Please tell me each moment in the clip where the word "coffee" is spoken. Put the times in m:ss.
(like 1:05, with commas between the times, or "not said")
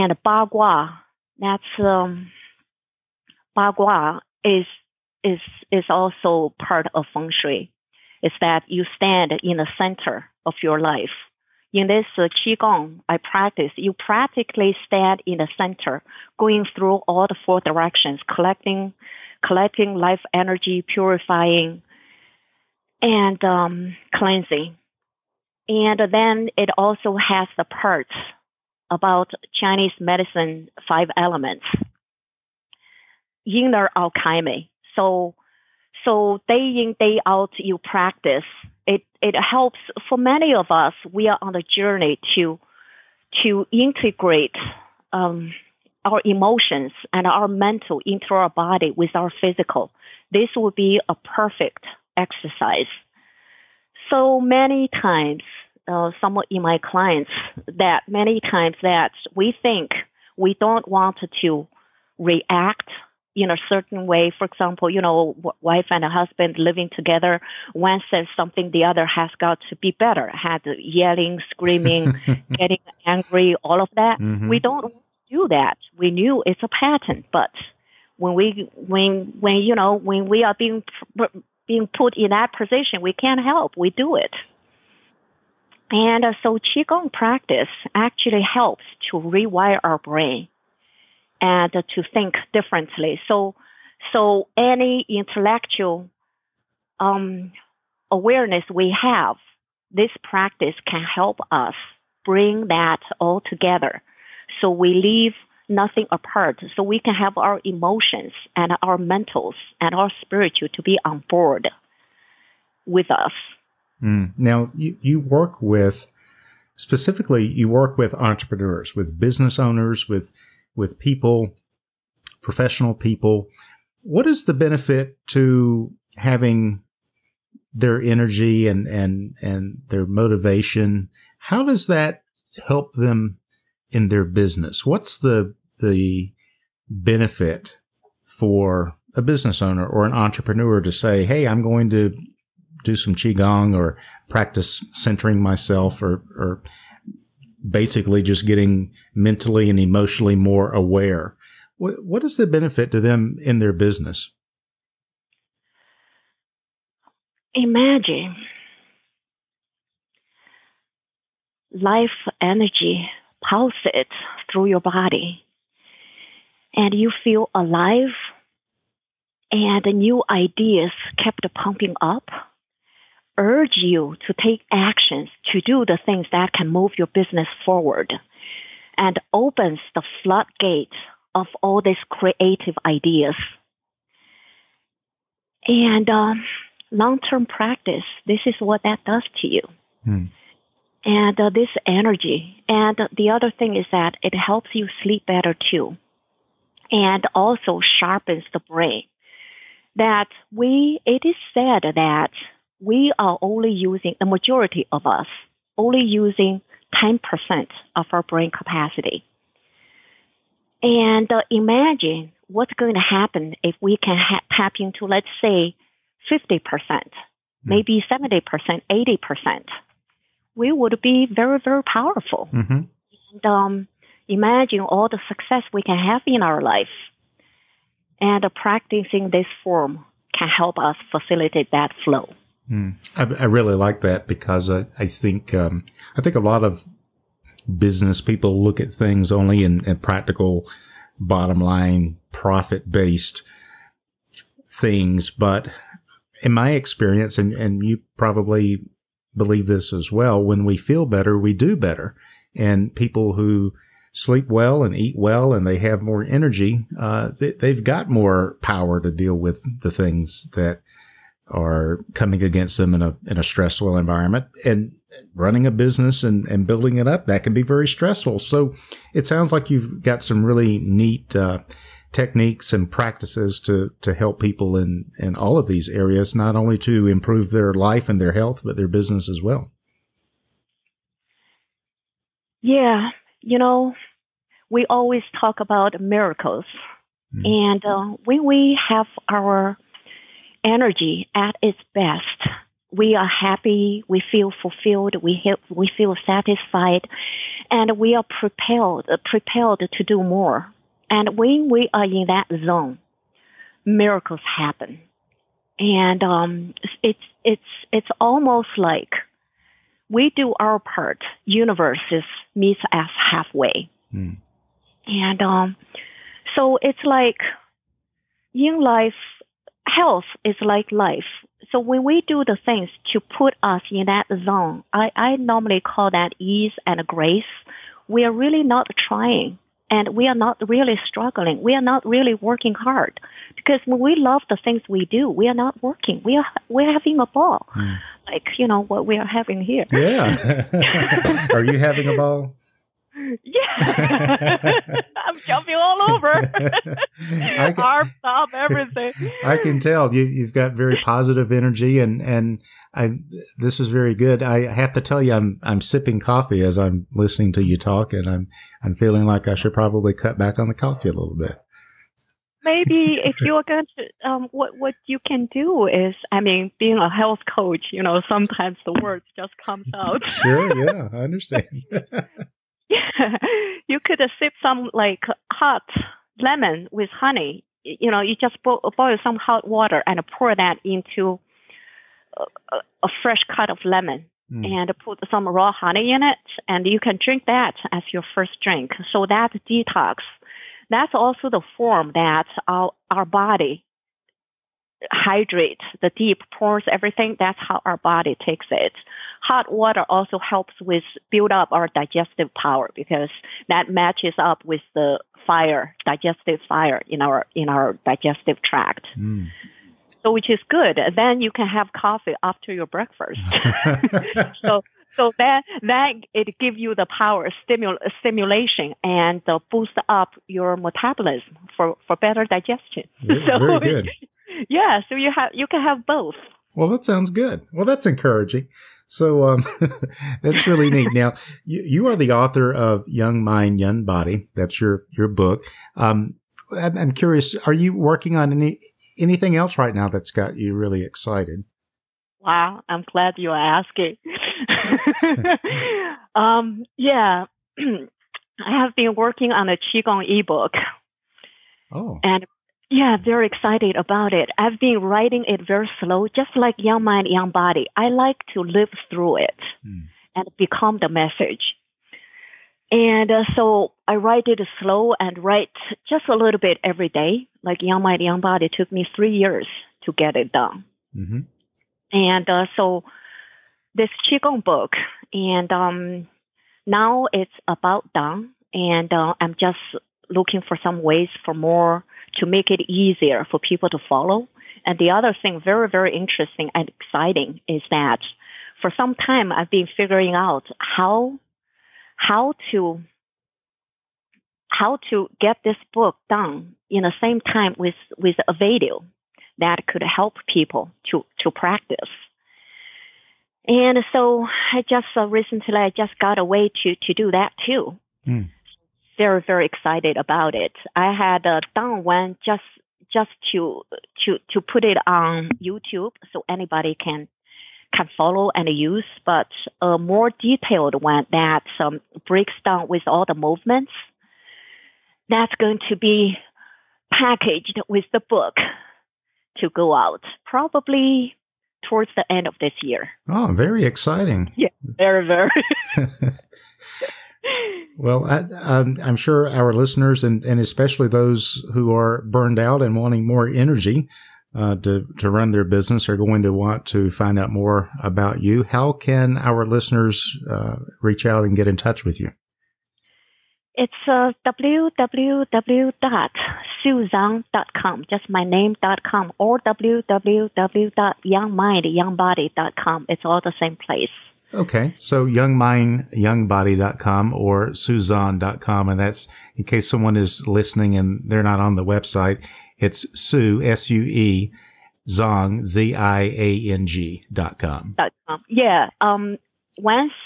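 5:56, 6:00, 6:51.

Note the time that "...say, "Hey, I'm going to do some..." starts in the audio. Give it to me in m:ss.
2:20.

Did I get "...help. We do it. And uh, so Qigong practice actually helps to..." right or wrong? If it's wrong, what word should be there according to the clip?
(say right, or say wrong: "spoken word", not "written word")
right.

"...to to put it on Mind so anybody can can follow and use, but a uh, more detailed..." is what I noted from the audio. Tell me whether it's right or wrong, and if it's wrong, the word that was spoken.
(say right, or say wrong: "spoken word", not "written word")
wrong: "YouTube", not "Mind".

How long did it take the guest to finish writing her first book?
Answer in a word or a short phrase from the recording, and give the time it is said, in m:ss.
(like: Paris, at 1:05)
3 years, at 7:49.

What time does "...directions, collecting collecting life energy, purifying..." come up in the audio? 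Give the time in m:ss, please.
0:17.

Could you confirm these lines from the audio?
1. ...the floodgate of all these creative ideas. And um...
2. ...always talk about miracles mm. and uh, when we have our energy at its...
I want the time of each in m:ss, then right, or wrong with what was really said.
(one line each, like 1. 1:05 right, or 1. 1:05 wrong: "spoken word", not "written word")
1. 2:59 right
2. 4:44 right.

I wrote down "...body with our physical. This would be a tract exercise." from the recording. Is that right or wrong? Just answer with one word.
wrong.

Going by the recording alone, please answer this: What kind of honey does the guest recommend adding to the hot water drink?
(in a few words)
Raw honey.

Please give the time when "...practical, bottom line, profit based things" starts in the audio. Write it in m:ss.
3:59.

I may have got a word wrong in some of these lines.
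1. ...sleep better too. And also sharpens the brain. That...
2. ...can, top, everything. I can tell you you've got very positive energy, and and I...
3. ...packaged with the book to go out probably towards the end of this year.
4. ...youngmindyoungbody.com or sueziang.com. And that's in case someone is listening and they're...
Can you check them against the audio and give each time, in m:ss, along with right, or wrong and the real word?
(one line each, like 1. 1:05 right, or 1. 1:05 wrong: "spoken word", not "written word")
1. 3:15 right
2. 5:47 right
3. 8:47 right
4. 9:25 right.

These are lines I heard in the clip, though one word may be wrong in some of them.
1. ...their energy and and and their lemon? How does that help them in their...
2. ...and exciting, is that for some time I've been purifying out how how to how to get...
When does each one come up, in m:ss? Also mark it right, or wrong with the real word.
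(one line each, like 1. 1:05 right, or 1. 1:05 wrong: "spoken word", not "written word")
1. 2:07 wrong: "motivation", not "lemon"
2. 8:06 wrong: "figuring", not "purifying".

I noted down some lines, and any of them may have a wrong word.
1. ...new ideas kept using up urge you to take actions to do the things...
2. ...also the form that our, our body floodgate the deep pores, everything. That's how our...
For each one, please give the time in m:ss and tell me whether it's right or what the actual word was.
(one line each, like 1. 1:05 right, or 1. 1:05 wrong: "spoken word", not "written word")
1. 2:49 wrong: "pumping", not "using"
2. 6:31 wrong: "hydrate", not "floodgate".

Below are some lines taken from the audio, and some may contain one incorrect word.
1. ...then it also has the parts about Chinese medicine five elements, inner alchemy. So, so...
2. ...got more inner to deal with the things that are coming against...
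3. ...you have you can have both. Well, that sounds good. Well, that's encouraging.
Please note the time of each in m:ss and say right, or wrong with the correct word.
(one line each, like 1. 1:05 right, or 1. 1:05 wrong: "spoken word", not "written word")
1. 0:26 right
2. 4:17 wrong: "power", not "inner"
3. 7:05 right.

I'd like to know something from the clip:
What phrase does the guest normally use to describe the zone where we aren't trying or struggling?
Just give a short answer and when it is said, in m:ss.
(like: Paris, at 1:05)
ease and grace, at 5:26.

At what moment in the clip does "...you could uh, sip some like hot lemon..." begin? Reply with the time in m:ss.
6:13.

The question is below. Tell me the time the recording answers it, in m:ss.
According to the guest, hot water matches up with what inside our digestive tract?
6:46.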